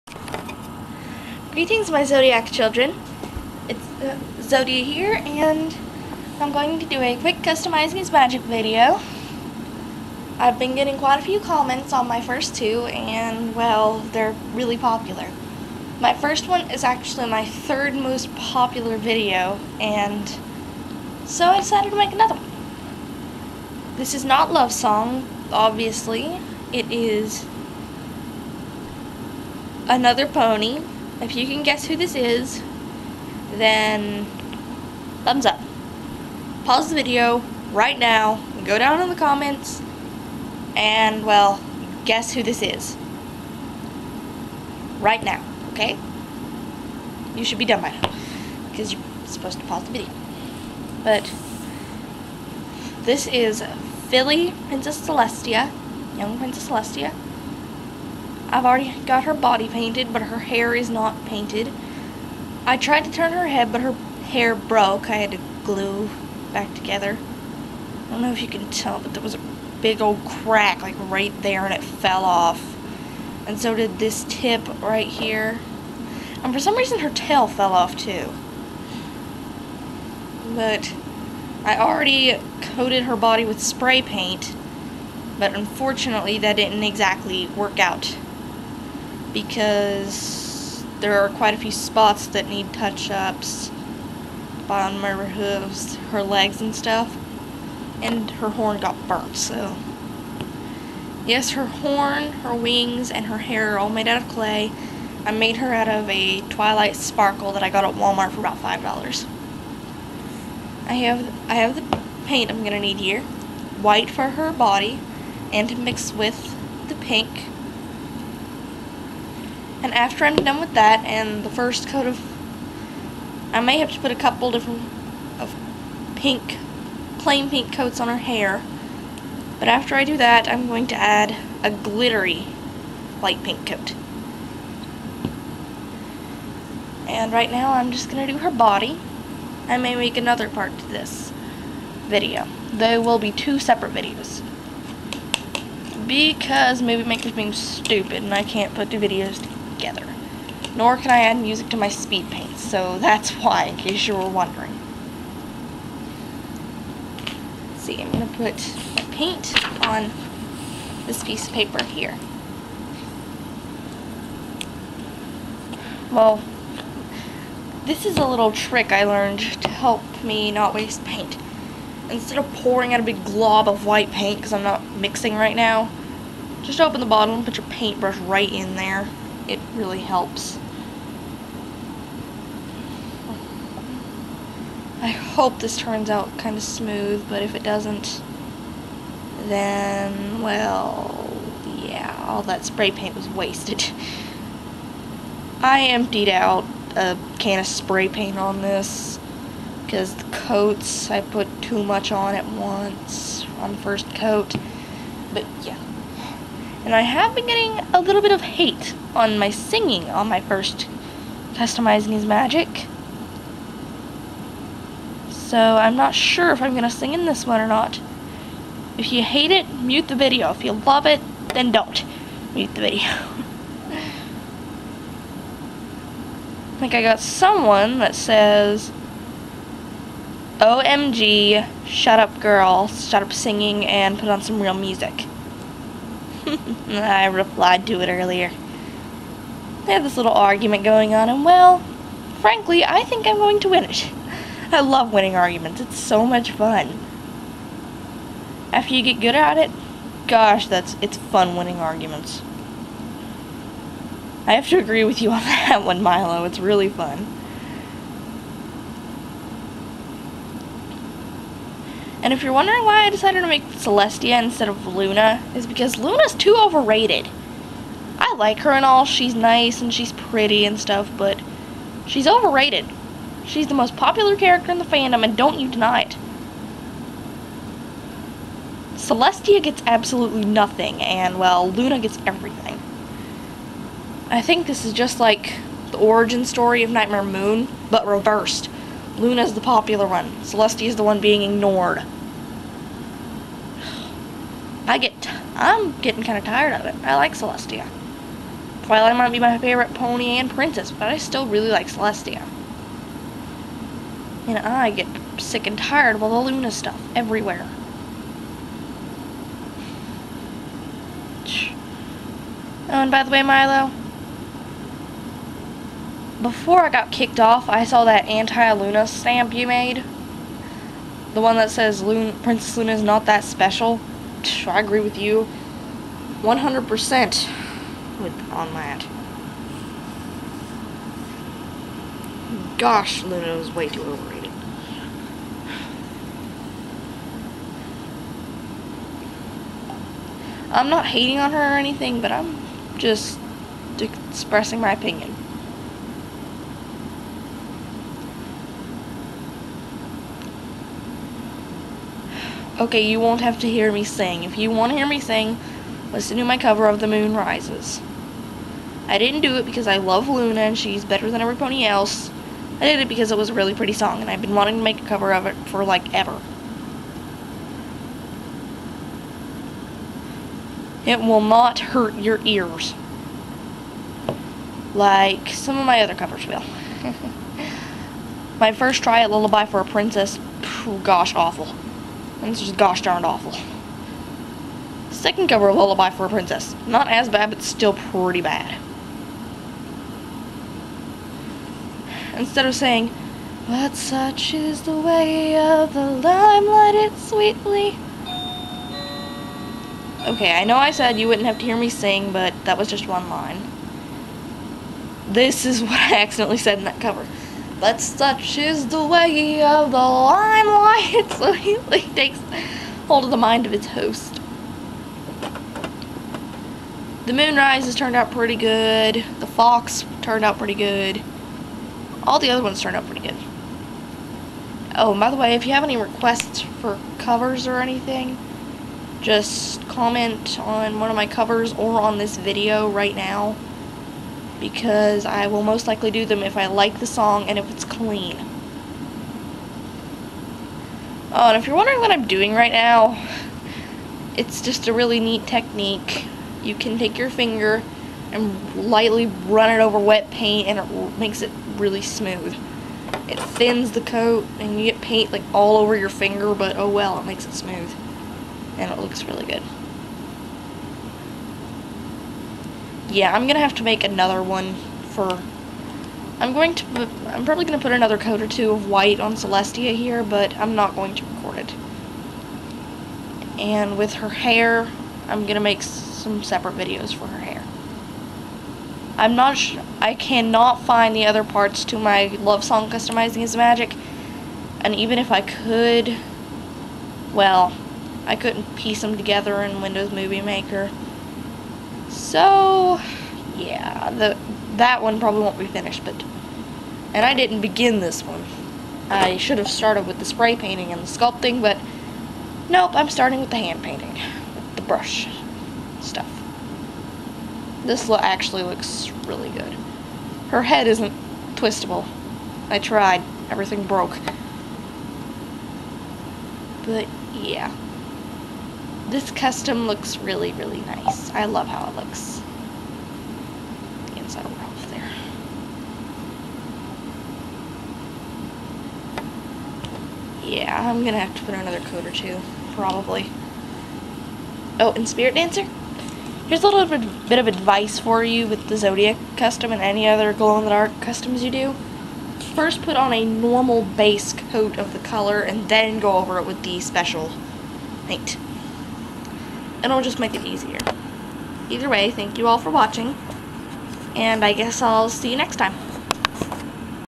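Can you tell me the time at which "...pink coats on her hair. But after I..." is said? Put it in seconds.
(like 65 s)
127 s.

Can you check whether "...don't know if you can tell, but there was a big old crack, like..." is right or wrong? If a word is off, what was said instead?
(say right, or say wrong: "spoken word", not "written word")
right.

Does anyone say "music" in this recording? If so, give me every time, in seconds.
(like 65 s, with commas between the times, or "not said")
151 s, 234 s.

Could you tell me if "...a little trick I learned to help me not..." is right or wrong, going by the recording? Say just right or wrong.
right.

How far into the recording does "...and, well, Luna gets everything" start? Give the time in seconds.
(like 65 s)
281 s.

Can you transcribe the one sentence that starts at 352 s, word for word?
Okay, you won't have to hear me sing.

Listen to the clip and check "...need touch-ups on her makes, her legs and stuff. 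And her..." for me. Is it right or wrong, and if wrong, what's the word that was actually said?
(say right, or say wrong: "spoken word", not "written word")
wrong: "hooves", not "makes".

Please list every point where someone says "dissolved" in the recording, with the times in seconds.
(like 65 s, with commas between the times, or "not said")
not said.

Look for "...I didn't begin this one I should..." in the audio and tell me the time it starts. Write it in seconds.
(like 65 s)
497 s.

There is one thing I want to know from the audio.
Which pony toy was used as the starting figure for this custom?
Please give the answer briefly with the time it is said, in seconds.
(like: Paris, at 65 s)
Twilight Sparkle, at 106 s.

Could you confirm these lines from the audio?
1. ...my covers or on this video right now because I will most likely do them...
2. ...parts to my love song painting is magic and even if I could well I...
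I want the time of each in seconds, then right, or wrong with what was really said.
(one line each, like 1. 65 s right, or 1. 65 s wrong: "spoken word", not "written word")
1. 431 s right
2. 481 s wrong: "customizing", not "painting".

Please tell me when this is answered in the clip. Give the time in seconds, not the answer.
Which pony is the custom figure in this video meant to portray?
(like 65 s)
54 s.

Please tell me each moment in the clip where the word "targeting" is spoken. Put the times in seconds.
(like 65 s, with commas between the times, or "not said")
not said.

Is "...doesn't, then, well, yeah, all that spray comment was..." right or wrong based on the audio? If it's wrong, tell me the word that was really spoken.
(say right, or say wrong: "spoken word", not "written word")
wrong: "paint", not "comment".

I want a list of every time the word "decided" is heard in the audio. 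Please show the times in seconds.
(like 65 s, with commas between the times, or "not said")
21 s, 263 s.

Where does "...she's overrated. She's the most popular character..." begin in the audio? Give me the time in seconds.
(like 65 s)
272 s.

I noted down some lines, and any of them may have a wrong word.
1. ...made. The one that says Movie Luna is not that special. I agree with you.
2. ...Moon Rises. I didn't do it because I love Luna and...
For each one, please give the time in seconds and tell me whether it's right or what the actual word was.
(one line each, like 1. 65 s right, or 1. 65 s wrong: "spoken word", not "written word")
1. 319 s wrong: "Princess", not "Movie"
2. 357 s right.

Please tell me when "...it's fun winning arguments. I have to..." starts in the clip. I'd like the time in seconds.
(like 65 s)
251 s.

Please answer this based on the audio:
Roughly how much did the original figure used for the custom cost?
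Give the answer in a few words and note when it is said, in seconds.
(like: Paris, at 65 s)
$5, at 108 s.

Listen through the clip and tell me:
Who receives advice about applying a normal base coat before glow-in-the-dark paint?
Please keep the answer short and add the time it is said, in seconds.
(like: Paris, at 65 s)
Spirit Dancer, at 535 s.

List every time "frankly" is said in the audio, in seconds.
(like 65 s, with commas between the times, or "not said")
242 s.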